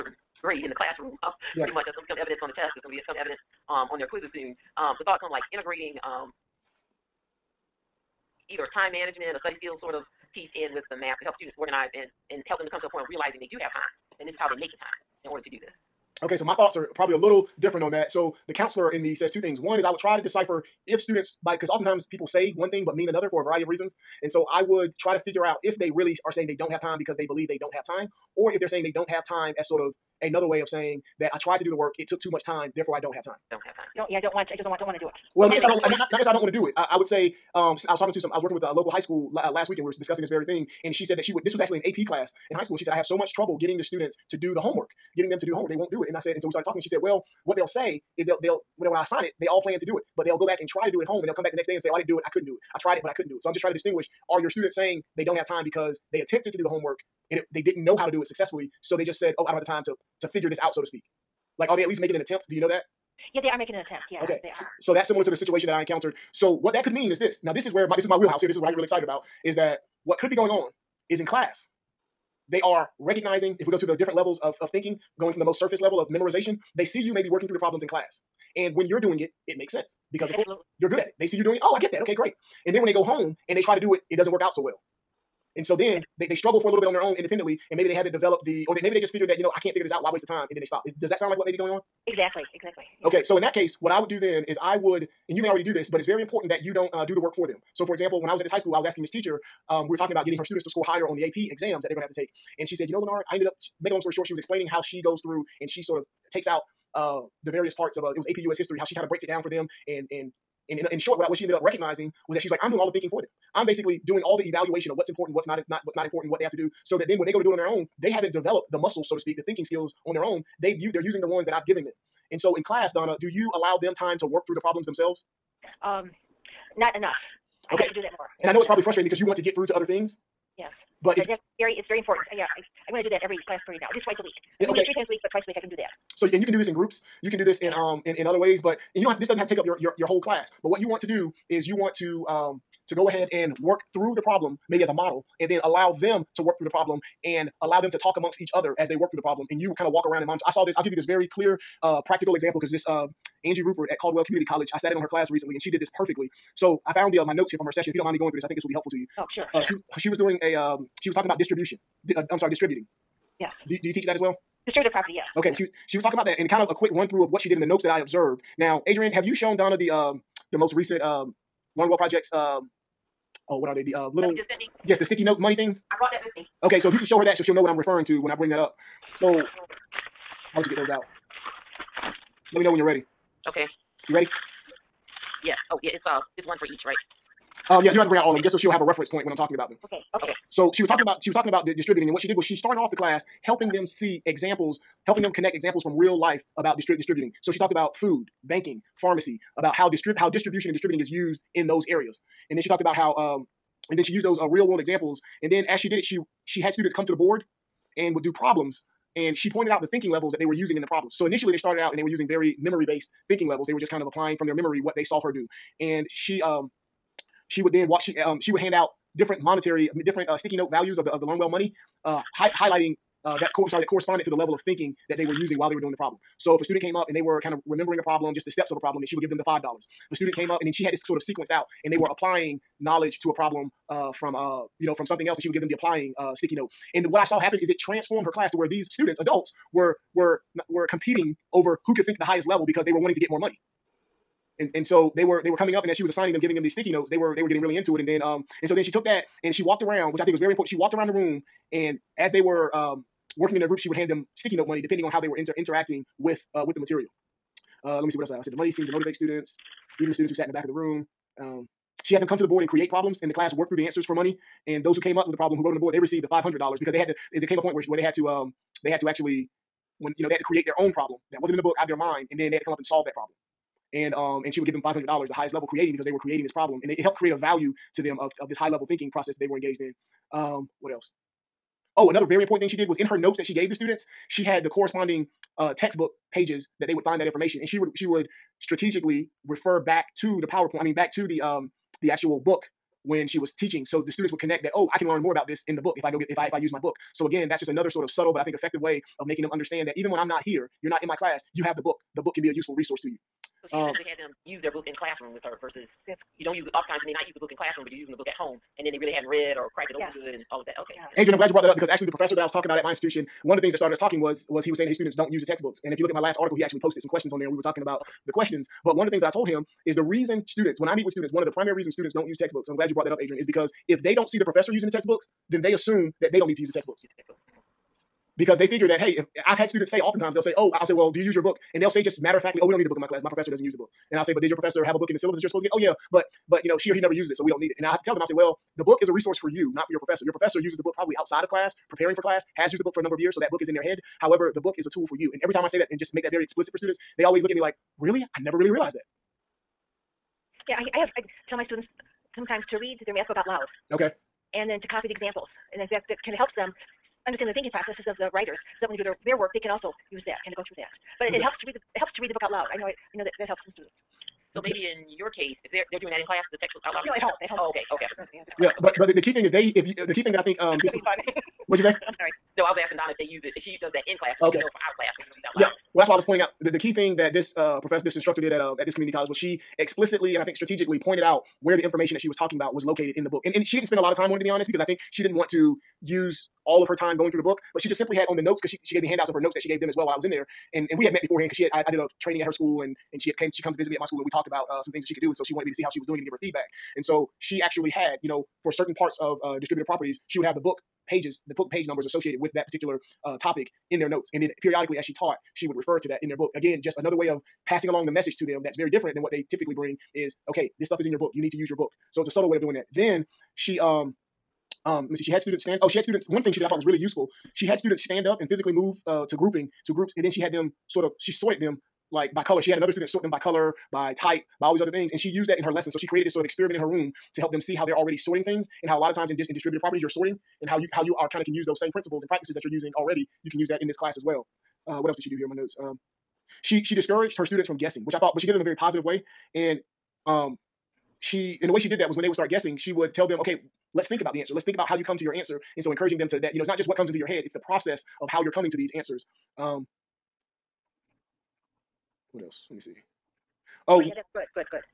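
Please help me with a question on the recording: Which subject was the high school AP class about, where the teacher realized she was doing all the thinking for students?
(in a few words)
US history.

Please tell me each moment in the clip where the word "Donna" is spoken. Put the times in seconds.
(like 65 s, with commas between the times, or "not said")
122 s, 169 s, 372 s.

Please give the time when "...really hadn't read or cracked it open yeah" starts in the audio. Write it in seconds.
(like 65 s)
308 s.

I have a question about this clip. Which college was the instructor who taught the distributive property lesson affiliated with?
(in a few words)
Caldwell Community College.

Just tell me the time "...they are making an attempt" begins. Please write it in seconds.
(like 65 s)
63 s.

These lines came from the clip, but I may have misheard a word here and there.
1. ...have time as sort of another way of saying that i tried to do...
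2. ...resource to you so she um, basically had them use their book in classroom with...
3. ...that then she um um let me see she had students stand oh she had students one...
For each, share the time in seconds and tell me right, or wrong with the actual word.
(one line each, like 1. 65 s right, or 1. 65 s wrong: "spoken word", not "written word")
1. 29 s right
2. 302 s wrong: "essentially", not "basically"
3. 412 s right.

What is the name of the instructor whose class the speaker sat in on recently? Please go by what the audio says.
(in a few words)
Angie Rupert.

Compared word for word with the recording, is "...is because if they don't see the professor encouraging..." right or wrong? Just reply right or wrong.
wrong.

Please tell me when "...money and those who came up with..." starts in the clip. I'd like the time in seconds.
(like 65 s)
264 s.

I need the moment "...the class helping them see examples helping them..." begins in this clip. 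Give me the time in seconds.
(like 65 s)
192 s.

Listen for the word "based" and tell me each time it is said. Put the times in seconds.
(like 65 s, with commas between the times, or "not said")
212 s.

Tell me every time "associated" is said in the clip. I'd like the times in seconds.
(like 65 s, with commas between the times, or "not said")
402 s.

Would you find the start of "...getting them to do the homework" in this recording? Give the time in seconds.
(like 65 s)
45 s.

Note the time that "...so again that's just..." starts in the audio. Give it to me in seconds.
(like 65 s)
297 s.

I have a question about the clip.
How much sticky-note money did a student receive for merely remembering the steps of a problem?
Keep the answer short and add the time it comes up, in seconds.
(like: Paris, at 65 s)
$5, at 229 s.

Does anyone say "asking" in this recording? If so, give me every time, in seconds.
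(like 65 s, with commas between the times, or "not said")
98 s, 372 s.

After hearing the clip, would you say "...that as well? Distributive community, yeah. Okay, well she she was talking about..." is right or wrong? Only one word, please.
wrong.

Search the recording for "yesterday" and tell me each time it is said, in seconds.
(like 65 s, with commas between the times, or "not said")
not said.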